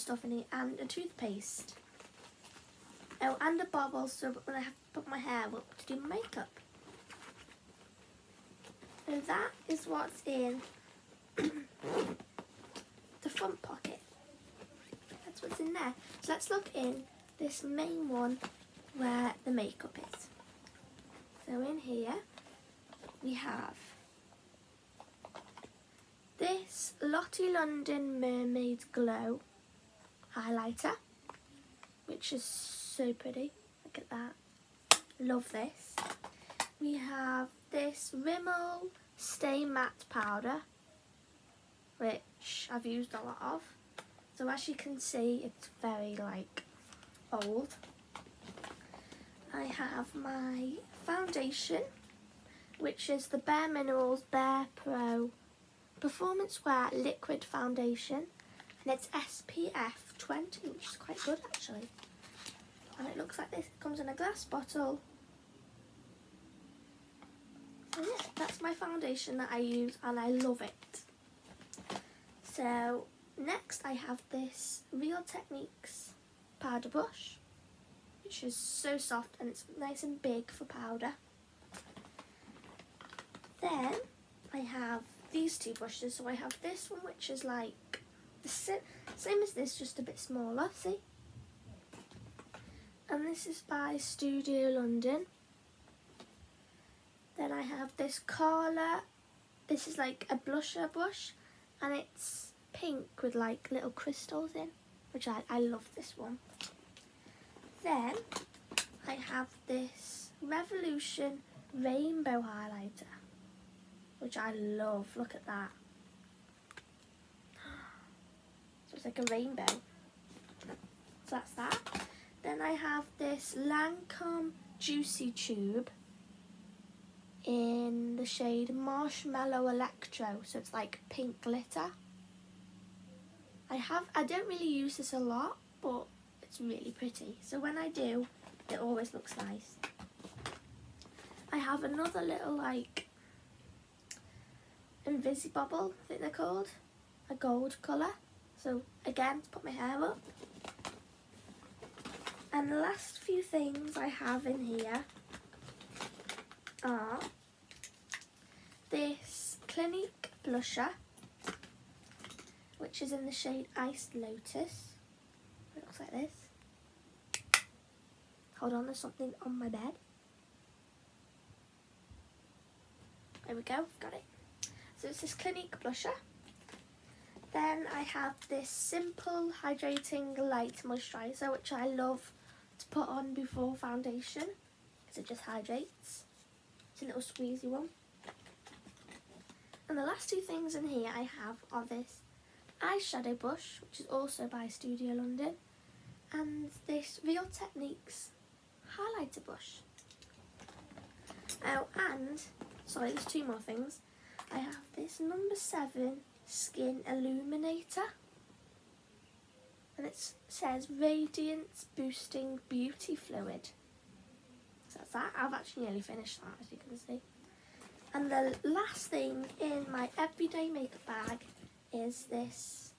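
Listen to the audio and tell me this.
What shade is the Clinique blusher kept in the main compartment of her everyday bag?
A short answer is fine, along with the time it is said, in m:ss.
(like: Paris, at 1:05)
Iced Lotus, at 2:43.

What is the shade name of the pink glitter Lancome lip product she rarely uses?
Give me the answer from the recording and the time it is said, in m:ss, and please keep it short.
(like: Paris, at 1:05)
Marshmallow Electro, at 2:08.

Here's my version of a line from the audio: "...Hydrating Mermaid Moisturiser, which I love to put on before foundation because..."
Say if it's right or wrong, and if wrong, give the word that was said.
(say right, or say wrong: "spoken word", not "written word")
wrong: "Light", not "Mermaid".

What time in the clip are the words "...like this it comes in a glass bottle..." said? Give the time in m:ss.
1:03.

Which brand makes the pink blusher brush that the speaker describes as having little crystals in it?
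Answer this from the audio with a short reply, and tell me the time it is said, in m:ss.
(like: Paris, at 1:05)
Carla, at 1:38.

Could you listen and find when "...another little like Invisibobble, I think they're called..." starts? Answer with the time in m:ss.
2:21.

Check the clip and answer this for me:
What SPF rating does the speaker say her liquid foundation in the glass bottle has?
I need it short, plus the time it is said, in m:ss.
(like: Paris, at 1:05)
SPF 20, at 0:59.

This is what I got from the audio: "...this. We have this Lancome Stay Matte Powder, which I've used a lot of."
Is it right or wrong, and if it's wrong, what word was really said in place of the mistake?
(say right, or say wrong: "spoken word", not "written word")
wrong: "Rimmel", not "Lancome".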